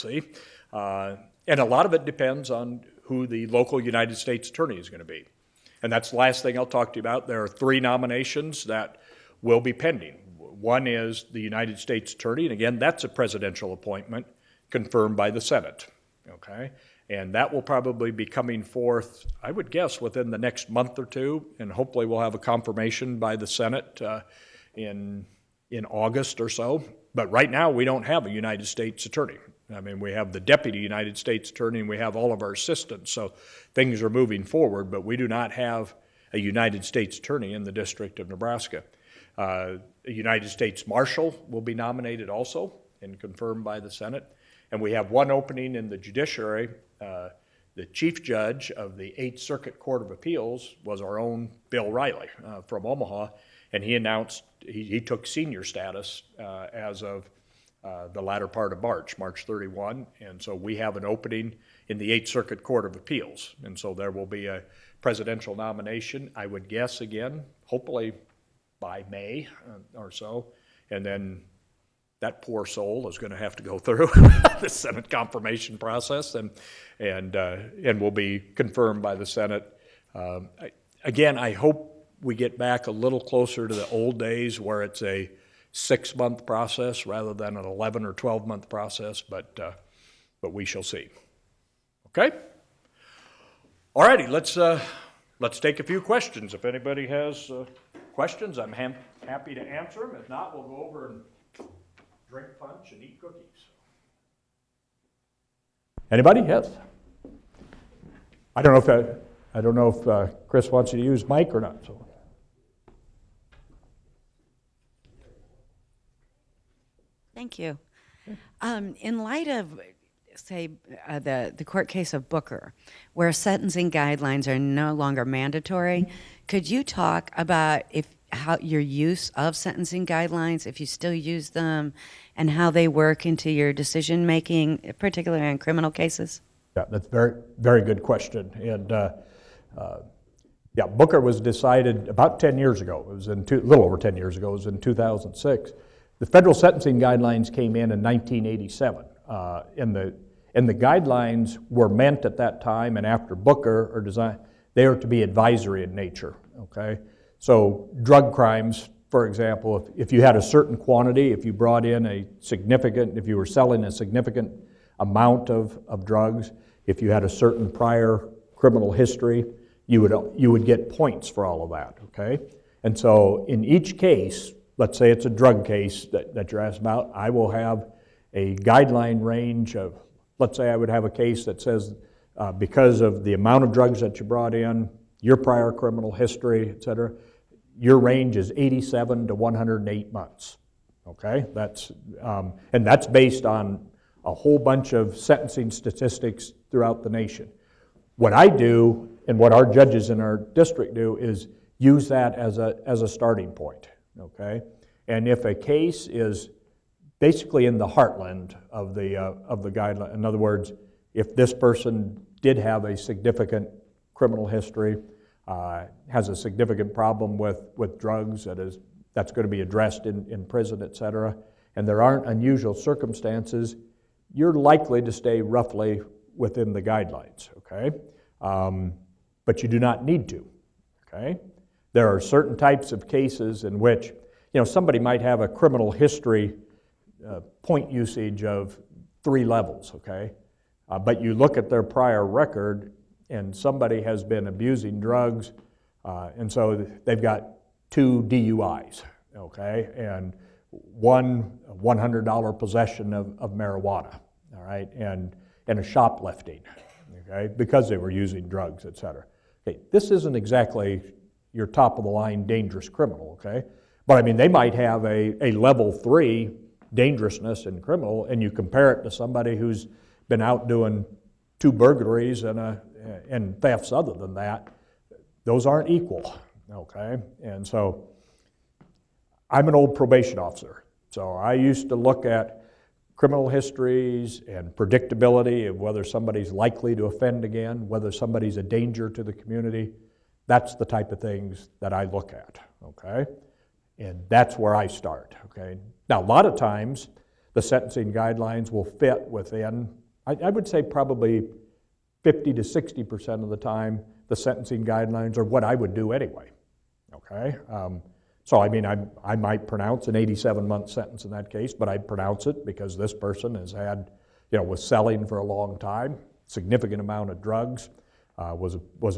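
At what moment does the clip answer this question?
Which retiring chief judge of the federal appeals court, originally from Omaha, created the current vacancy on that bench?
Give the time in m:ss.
0:51.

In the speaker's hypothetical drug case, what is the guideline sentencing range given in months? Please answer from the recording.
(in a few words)
87 to 108 months.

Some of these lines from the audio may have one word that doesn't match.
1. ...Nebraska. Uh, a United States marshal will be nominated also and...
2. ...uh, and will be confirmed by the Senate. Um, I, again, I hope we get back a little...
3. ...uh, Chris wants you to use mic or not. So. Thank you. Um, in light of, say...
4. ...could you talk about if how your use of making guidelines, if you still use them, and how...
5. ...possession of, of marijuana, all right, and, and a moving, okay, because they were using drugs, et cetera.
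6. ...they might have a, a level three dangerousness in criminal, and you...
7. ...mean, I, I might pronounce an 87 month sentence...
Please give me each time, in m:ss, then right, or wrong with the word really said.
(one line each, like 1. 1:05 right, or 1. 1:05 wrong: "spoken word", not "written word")
1. 0:38 right
2. 1:17 right
3. 1:50 right
4. 2:06 wrong: "sentencing", not "making"
5. 4:12 wrong: "shoplifting", not "moving"
6. 4:24 right
7. 5:08 right.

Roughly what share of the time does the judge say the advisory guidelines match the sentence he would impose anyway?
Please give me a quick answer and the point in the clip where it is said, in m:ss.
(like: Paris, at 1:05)
50 to 60%, at 5:02.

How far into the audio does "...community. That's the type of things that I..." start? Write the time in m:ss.
4:49.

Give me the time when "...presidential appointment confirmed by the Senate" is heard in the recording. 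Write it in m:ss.
0:13.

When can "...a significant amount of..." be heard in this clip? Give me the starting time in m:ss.
2:43.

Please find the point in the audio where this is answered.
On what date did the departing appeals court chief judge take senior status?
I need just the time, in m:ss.
0:59.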